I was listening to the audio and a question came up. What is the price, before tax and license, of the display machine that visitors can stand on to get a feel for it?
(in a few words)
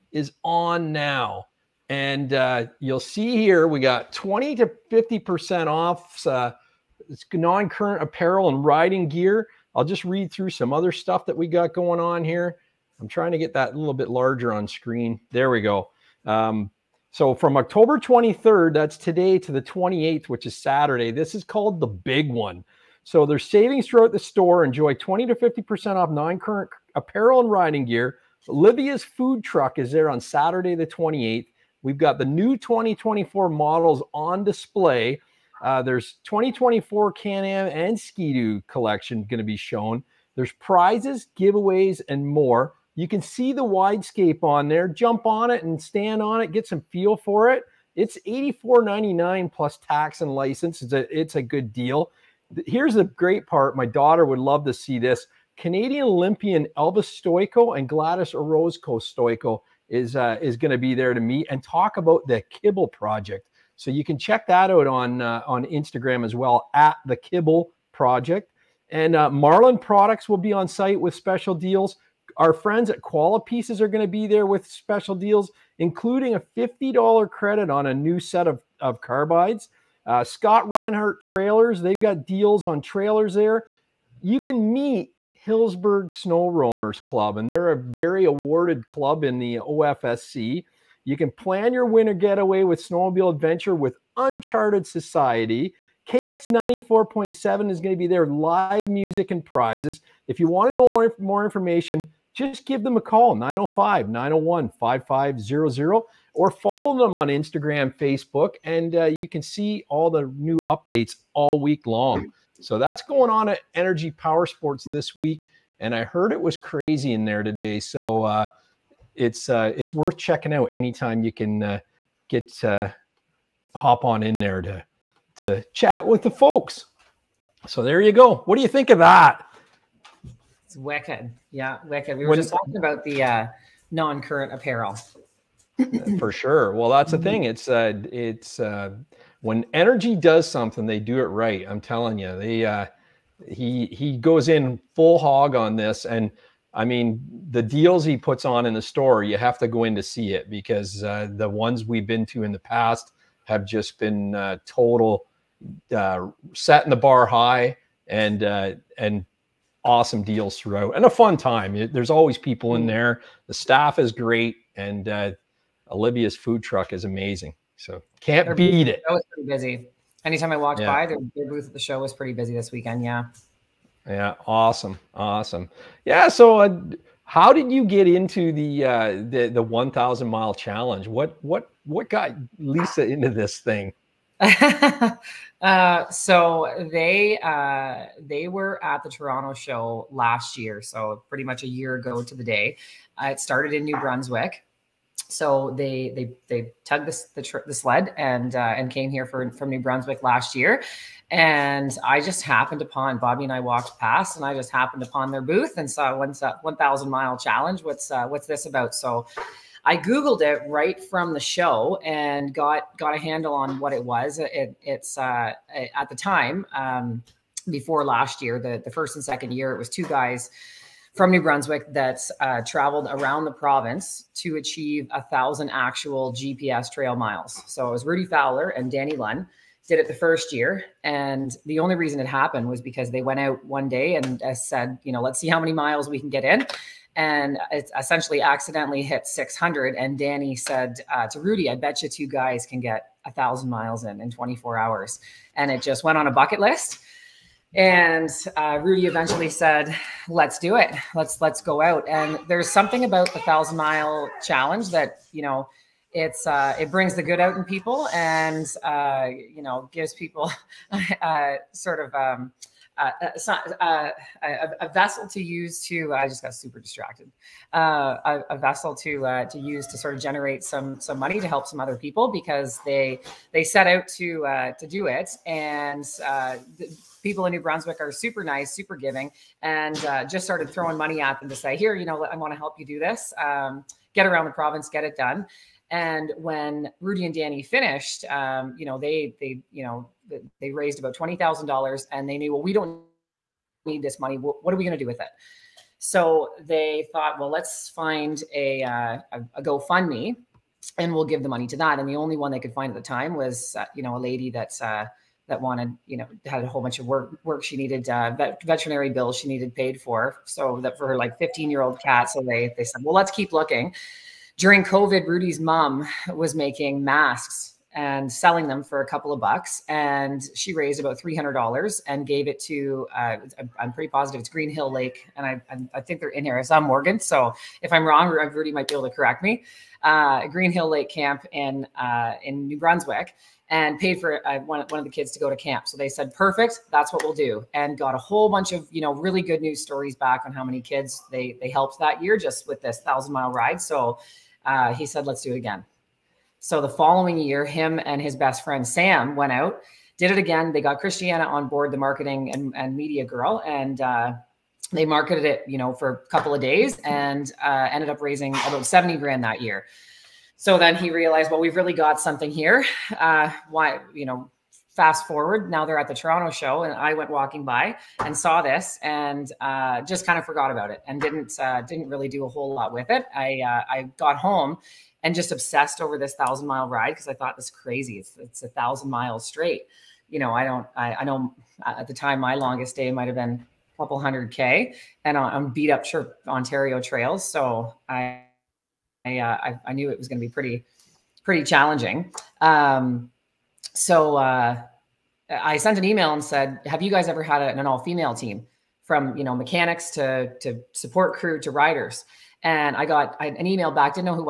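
$84.99.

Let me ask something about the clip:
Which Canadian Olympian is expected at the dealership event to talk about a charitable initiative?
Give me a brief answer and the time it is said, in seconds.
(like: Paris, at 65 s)
Elvis Stojko, at 56 s.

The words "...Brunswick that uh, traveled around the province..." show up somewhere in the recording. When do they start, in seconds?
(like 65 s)
221 s.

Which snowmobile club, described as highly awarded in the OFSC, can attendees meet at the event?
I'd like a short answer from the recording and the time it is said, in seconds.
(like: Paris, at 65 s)
Hillsburgh Snow Roamers Club, at 85 s.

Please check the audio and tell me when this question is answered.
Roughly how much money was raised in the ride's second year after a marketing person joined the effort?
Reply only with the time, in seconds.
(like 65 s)
358 s.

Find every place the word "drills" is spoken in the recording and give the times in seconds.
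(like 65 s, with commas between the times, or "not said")
not said.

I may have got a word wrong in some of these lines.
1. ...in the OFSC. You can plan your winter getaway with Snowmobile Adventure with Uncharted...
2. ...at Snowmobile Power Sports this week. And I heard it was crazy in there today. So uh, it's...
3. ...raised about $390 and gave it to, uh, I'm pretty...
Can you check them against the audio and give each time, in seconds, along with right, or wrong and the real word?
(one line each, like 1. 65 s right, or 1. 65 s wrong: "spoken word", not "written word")
1. 89 s right
2. 113 s wrong: "Energy", not "Snowmobile"
3. 320 s wrong: "300", not "390".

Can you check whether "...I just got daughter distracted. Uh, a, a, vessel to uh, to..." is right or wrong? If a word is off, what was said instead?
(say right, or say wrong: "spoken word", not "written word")
wrong: "super", not "daughter".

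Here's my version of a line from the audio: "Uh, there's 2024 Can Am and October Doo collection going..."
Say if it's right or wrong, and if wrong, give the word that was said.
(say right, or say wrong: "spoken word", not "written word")
wrong: "Ski", not "October".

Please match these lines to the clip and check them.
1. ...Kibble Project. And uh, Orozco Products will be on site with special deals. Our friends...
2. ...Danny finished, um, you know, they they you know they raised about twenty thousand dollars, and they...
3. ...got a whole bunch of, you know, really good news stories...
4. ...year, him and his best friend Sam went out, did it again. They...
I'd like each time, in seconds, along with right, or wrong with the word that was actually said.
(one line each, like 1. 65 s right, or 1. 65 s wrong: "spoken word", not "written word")
1. 67 s wrong: "Marlin", not "Orozco"
2. 287 s right
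3. 337 s right
4. 347 s right.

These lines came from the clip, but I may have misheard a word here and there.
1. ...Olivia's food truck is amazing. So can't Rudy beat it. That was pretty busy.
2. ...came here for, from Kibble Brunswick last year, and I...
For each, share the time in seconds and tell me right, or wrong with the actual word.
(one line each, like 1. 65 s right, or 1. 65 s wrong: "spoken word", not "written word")
1. 165 s wrong: "Their", not "Rudy"
2. 198 s wrong: "New", not "Kibble".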